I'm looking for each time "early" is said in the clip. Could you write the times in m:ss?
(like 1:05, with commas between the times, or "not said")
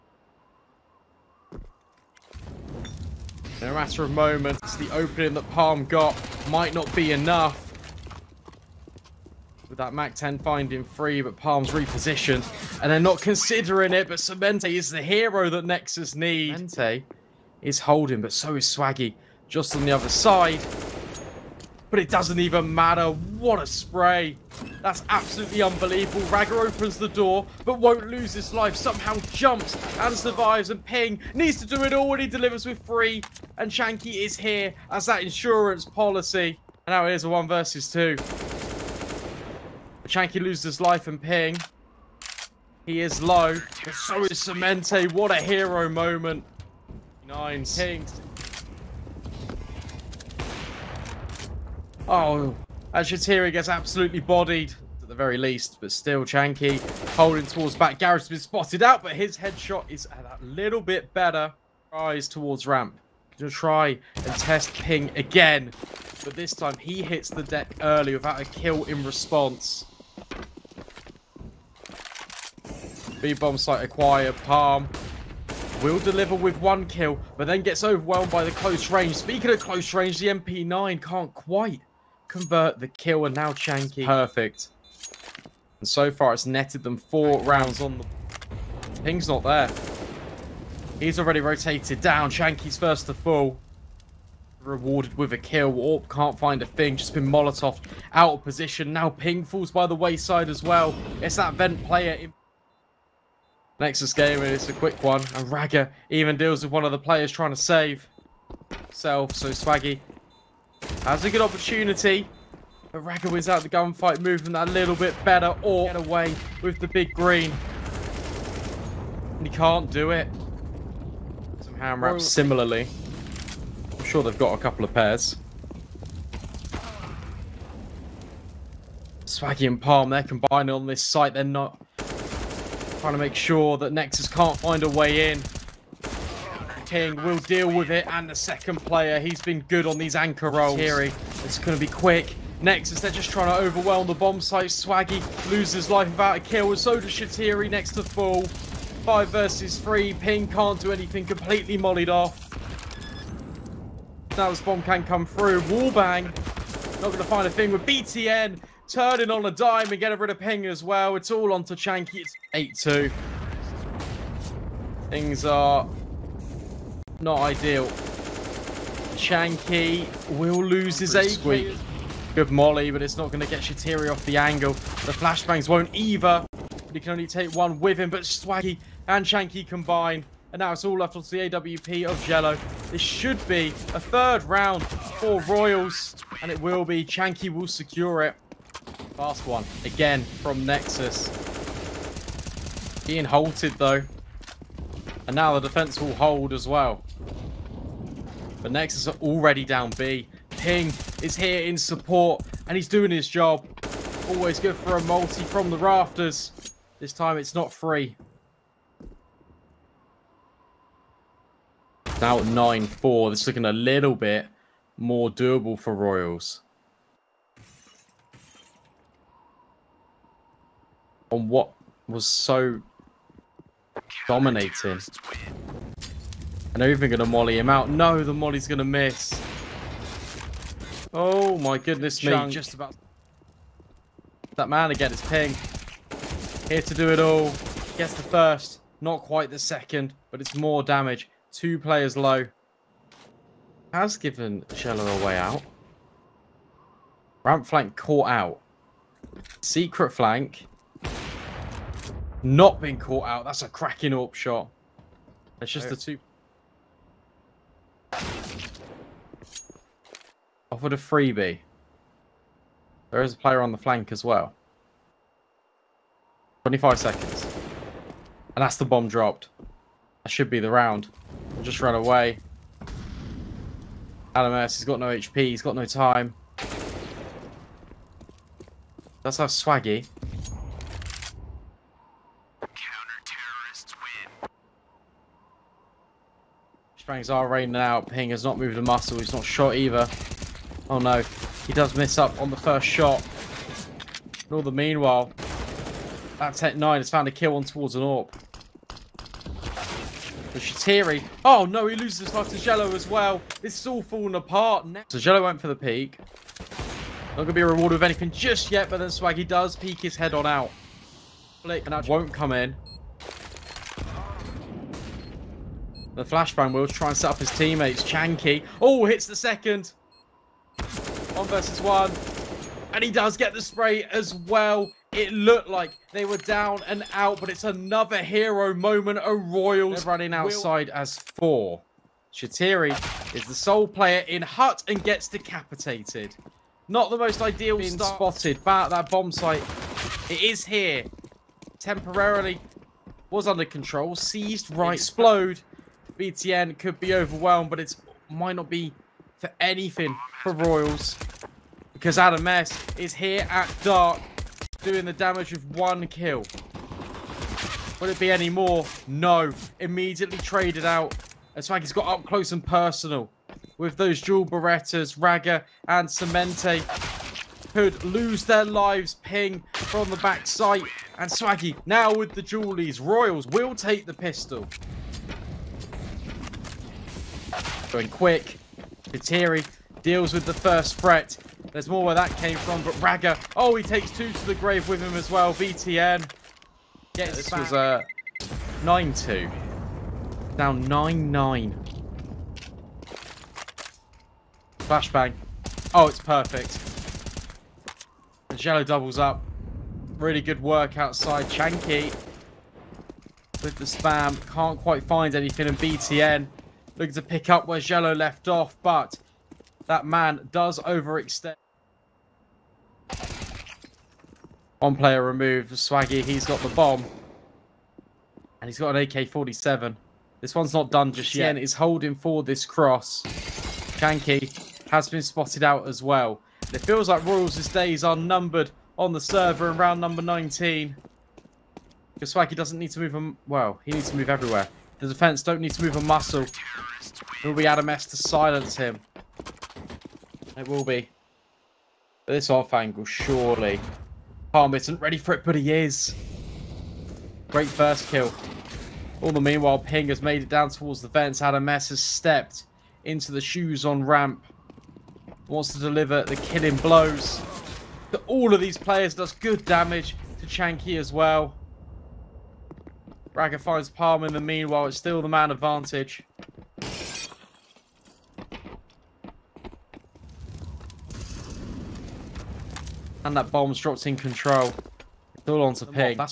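1:07.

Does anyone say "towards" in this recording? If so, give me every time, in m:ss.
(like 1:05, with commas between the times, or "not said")
0:57, 1:02, 4:57, 7:30.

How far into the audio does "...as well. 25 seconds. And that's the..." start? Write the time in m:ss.
4:24.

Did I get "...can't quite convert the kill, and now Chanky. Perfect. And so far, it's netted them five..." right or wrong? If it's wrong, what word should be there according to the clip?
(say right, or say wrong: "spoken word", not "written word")
wrong: "four", not "five".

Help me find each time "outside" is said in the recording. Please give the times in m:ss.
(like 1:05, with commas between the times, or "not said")
5:30, 6:40.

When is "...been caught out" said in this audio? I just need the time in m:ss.
4:12.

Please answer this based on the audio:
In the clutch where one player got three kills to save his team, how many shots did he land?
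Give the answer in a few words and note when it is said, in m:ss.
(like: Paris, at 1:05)
9, at 0:47.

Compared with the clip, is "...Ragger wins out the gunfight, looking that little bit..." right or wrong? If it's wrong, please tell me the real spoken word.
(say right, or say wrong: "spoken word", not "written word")
wrong: "moving", not "looking".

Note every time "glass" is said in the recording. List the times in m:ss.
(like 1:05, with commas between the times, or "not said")
not said.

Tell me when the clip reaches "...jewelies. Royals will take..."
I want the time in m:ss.
6:12.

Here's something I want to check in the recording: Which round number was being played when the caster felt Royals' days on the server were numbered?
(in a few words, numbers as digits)
19.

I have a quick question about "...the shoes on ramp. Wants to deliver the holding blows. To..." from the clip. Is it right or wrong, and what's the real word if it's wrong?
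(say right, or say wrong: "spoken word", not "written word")
wrong: "killing", not "holding".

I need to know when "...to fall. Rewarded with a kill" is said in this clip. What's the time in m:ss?
1:33.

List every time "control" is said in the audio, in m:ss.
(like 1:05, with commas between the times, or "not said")
5:43, 7:54.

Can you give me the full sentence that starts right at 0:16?
Cemente is holding, but so is Swaggy, just on the other side.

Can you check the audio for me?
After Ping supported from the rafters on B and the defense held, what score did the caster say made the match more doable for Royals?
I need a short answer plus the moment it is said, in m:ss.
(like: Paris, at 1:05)
9-4, at 3:32.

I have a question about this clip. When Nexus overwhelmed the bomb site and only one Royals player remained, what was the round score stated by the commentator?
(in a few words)
8-2.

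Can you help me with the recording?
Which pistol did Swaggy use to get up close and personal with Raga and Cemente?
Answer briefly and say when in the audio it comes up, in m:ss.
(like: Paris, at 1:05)
dual Berettas, at 6:04.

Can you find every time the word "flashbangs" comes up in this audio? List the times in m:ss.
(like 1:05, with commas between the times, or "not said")
2:55, 5:16, 6:34.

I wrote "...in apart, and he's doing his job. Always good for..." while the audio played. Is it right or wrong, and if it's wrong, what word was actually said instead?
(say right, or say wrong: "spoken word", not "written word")
wrong: "support", not "apart".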